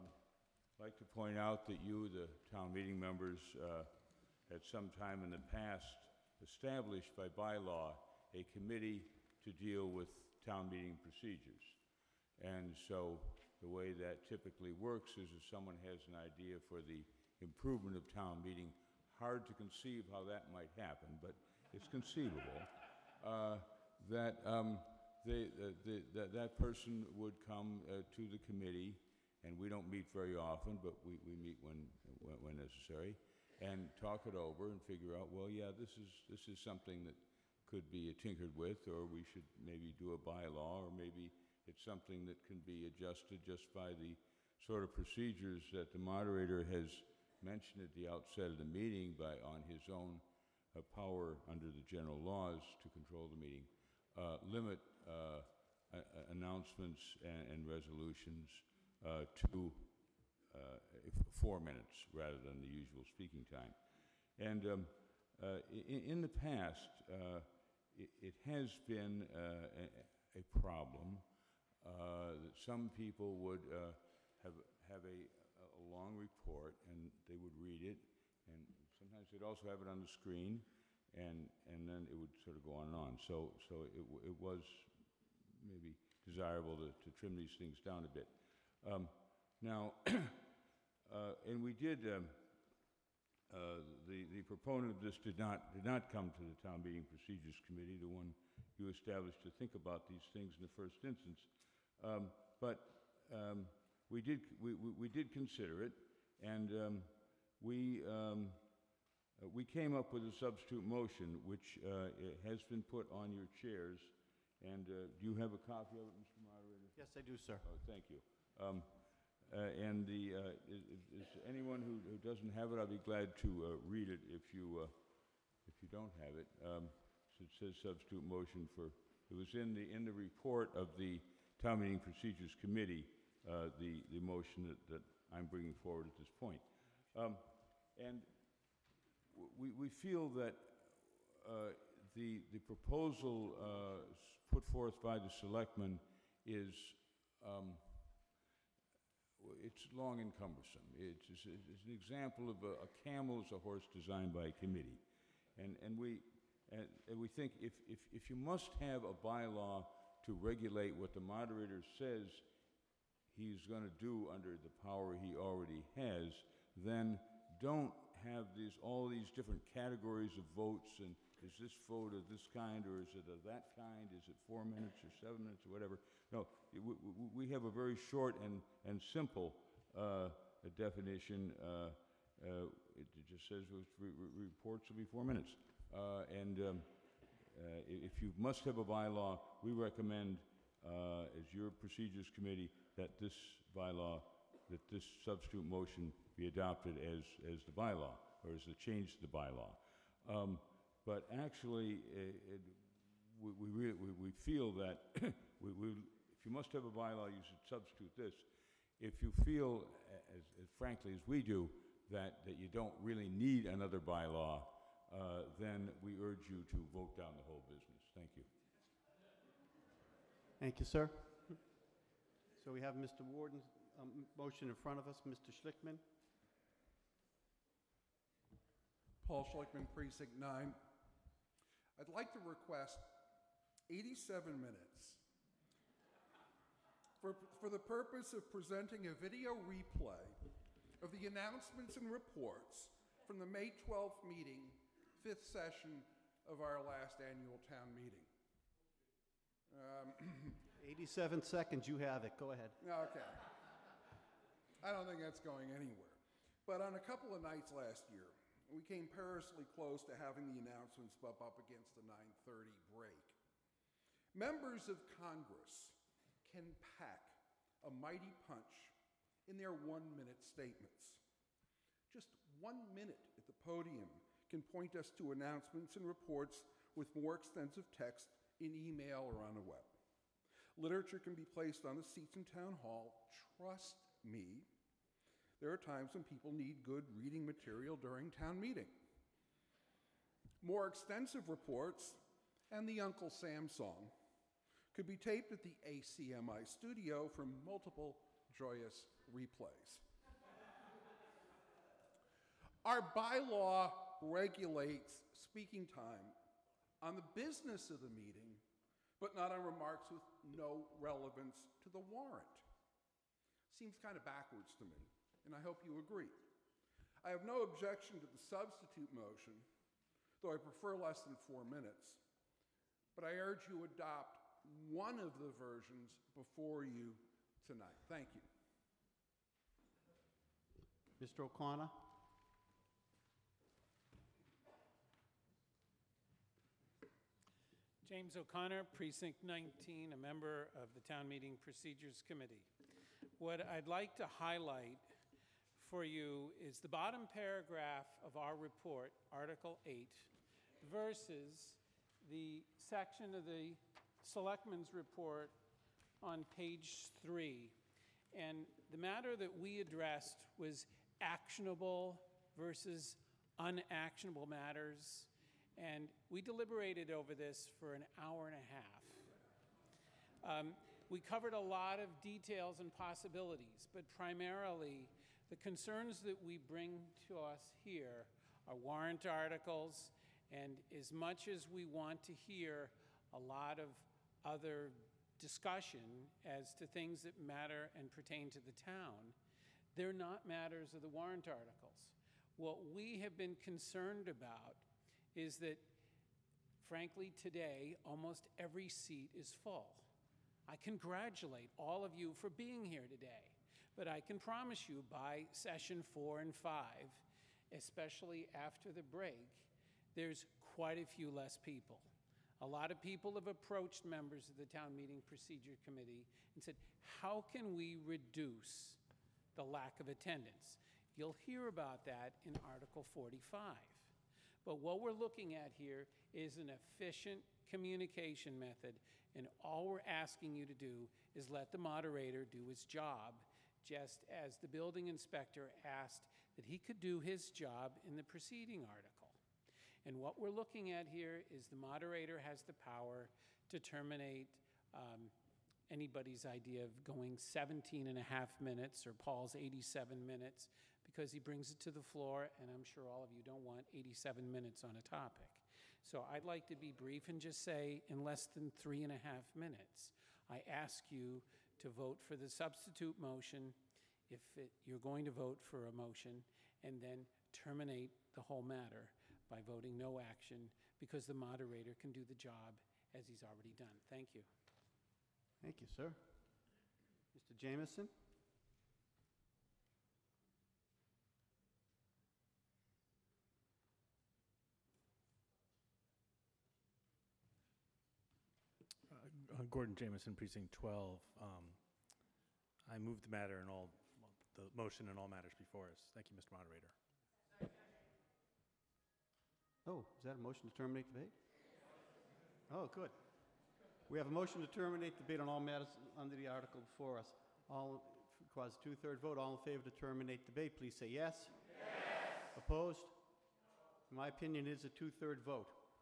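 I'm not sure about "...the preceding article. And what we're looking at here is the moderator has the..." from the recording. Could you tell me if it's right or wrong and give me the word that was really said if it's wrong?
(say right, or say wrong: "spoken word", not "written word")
right.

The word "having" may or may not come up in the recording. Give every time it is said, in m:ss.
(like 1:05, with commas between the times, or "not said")
4:20.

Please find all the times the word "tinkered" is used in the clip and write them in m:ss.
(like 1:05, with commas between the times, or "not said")
0:38.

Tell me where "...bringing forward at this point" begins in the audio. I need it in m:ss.
2:15.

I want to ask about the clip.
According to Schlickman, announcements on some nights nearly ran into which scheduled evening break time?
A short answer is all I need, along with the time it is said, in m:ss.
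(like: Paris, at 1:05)
9:30, at 4:22.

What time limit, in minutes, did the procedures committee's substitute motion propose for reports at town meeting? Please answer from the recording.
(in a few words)
4.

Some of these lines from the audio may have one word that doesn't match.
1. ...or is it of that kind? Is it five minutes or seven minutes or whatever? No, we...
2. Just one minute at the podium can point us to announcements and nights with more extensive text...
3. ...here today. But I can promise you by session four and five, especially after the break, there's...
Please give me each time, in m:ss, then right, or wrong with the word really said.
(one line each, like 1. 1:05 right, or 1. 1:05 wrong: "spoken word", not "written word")
1. 2:52 wrong: "four", not "five"
2. 4:32 wrong: "reports", not "nights"
3. 6:42 right.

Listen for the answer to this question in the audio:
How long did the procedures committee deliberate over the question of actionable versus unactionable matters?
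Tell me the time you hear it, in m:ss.
6:07.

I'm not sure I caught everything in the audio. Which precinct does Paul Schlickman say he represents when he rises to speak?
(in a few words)
Precinct 9.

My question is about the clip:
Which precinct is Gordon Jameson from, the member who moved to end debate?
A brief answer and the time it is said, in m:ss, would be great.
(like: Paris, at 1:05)
Precinct 12, at 8:10.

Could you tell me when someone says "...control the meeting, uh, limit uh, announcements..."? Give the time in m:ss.
0:52.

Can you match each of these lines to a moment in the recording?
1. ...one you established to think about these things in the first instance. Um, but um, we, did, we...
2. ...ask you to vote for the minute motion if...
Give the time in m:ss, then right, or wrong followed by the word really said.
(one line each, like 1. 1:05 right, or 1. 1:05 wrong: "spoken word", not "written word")
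1. 1:38 right
2. 7:40 wrong: "substitute", not "minute".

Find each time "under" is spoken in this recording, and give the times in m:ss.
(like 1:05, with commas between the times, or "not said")
0:51, 2:44, 8:26.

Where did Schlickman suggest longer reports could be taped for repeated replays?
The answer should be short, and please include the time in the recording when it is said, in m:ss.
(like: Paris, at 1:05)
ACMI studio, at 4:55.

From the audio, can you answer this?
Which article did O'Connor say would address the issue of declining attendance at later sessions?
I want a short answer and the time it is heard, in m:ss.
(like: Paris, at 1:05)
Article 45, at 7:02.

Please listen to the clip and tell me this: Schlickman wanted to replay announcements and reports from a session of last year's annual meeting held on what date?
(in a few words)
May 12th.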